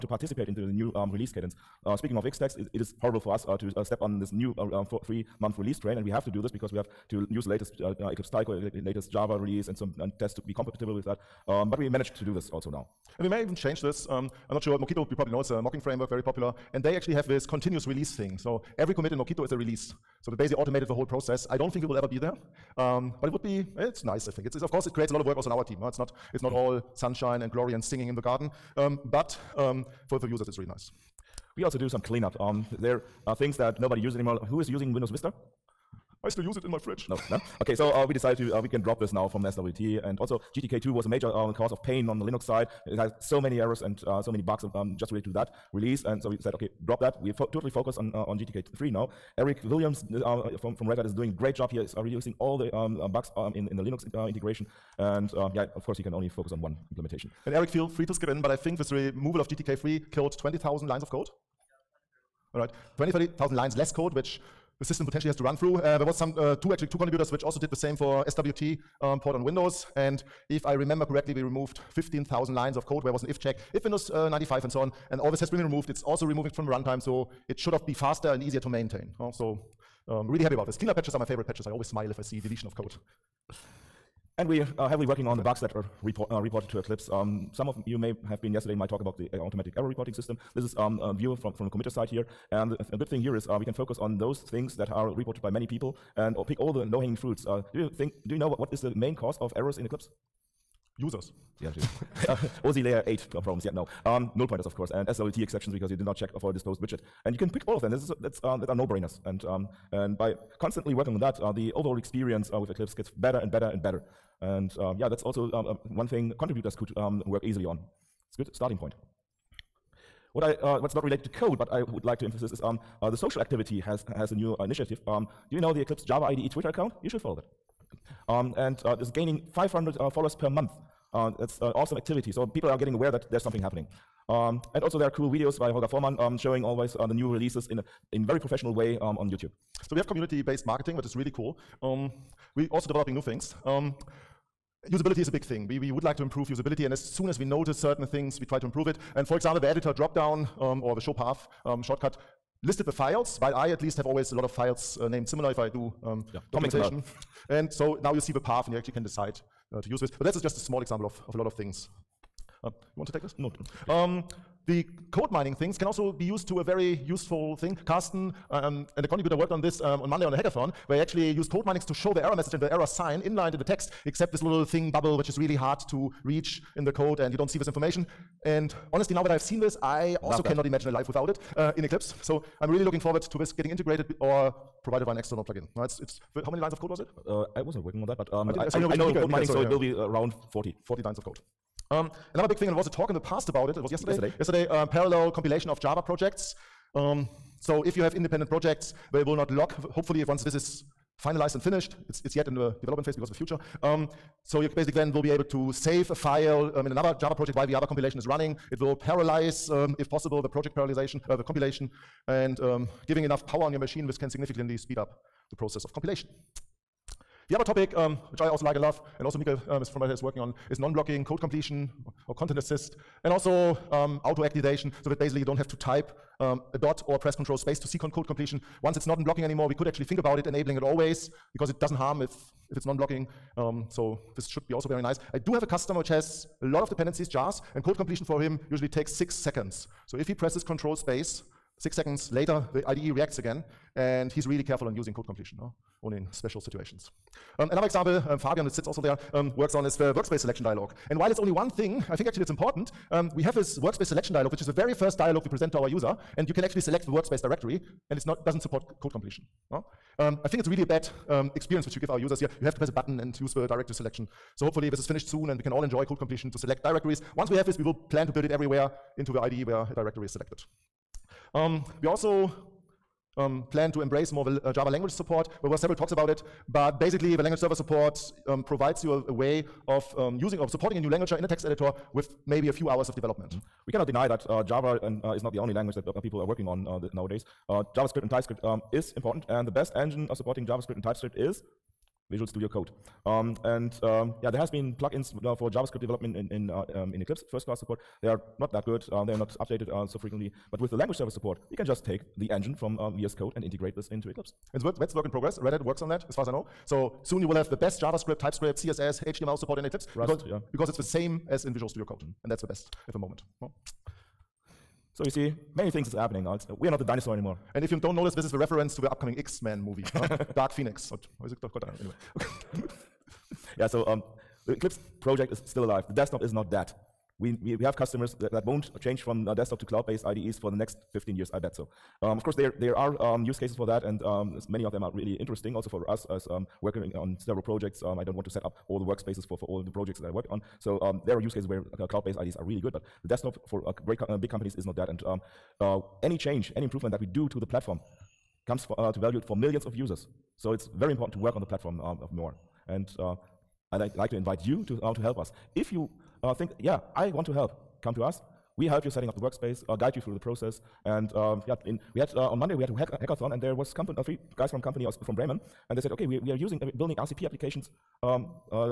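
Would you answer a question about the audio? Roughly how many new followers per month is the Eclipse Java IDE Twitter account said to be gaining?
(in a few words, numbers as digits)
500.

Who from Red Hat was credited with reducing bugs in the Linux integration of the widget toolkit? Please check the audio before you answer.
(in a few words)
Eric Williams.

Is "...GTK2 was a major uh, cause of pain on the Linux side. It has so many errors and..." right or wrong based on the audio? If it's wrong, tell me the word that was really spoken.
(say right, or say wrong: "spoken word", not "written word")
right.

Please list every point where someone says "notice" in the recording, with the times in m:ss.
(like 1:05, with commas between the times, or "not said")
2:27, 5:18.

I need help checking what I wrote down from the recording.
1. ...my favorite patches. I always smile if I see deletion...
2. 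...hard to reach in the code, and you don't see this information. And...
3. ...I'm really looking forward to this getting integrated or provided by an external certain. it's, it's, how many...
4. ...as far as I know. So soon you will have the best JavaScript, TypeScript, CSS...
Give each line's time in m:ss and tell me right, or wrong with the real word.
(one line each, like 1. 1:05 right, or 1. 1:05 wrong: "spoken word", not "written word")
1. 1:21 right
2. 2:55 right
3. 3:02 wrong: "plugin", not "certain"
4. 5:06 right.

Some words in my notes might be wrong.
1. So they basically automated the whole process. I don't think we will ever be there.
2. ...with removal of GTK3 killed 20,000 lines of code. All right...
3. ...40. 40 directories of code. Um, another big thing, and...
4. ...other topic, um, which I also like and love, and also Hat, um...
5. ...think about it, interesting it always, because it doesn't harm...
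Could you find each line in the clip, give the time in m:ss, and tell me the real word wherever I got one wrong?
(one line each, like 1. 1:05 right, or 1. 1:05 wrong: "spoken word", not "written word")
1. 0:20 right
2. 0:58 right
3. 3:10 wrong: "lines", not "directories"
4. 3:37 wrong: "Mika", not "Hat"
5. 3:50 wrong: "enabling", not "interesting".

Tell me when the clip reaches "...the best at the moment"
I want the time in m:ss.
5:12.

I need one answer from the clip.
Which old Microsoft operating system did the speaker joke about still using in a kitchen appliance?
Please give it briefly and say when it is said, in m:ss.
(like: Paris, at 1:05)
Windows Vista, at 0:34.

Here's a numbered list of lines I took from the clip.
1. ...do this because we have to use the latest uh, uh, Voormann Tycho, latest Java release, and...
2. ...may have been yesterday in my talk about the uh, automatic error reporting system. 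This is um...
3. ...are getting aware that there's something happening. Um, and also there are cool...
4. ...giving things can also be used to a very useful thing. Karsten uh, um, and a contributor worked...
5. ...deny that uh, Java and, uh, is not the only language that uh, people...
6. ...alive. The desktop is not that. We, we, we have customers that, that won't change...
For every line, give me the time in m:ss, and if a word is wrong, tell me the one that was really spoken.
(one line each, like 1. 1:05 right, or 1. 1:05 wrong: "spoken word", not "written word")
1. 0:06 wrong: "Eclipse", not "Voormann"
2. 1:27 right
3. 2:12 right
4. 2:45 wrong: "mining", not "giving"
5. 4:44 right
6. 5:25 right.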